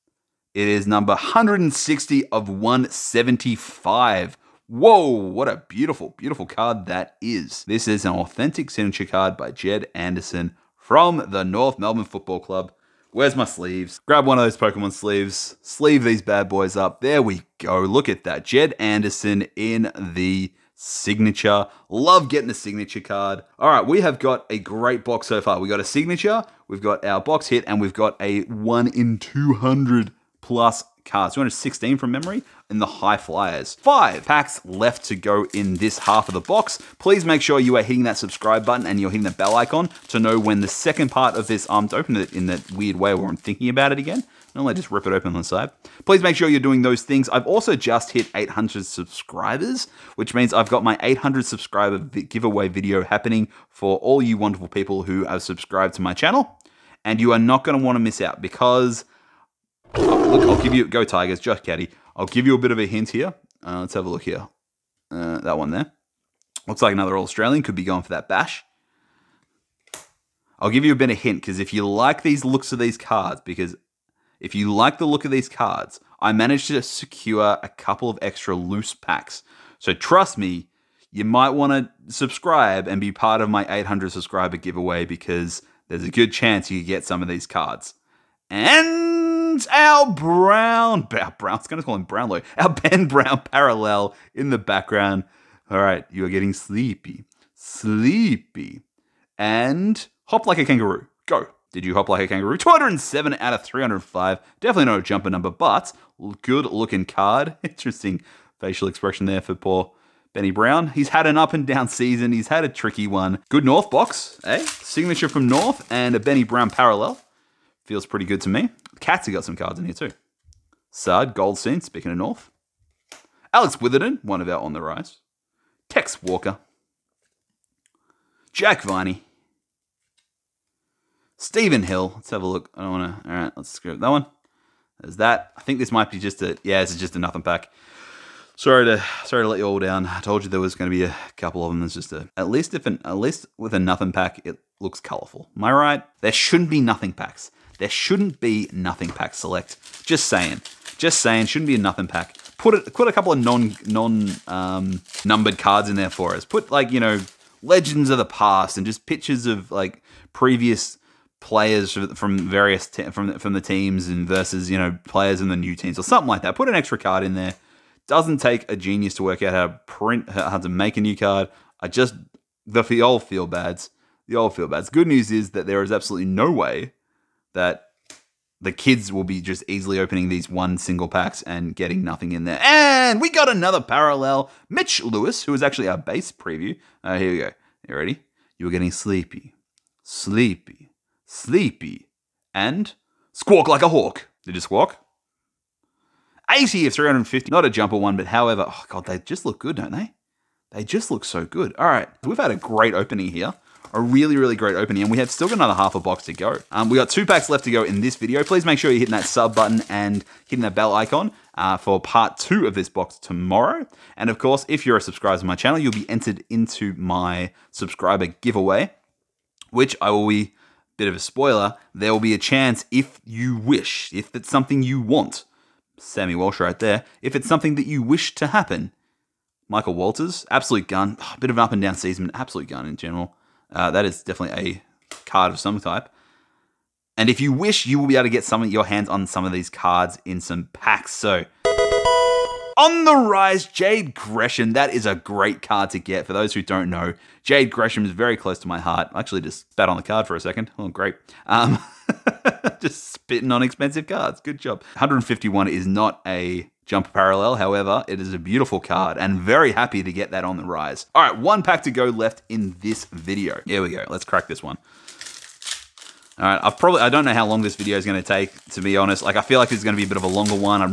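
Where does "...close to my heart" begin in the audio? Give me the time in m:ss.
4:08.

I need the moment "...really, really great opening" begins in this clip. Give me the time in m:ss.
3:24.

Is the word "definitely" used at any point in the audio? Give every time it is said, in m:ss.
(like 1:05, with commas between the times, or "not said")
1:44, 3:54.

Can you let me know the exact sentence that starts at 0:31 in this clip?
216 from memory in the high flyers.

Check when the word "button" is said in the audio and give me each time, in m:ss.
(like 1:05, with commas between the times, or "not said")
0:38, 3:29.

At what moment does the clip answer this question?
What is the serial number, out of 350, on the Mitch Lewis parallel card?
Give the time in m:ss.
3:16.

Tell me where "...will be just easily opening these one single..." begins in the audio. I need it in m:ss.
2:59.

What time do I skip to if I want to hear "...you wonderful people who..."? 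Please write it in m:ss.
0:54.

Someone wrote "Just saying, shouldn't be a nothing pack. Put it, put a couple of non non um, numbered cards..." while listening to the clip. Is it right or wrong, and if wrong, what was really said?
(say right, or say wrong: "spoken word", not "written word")
right.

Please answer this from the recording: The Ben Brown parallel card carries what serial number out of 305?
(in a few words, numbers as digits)
207.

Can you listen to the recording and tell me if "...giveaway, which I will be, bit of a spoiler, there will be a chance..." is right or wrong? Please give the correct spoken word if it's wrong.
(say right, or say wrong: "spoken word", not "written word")
right.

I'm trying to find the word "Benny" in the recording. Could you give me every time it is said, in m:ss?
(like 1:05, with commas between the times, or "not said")
1:50, 1:56.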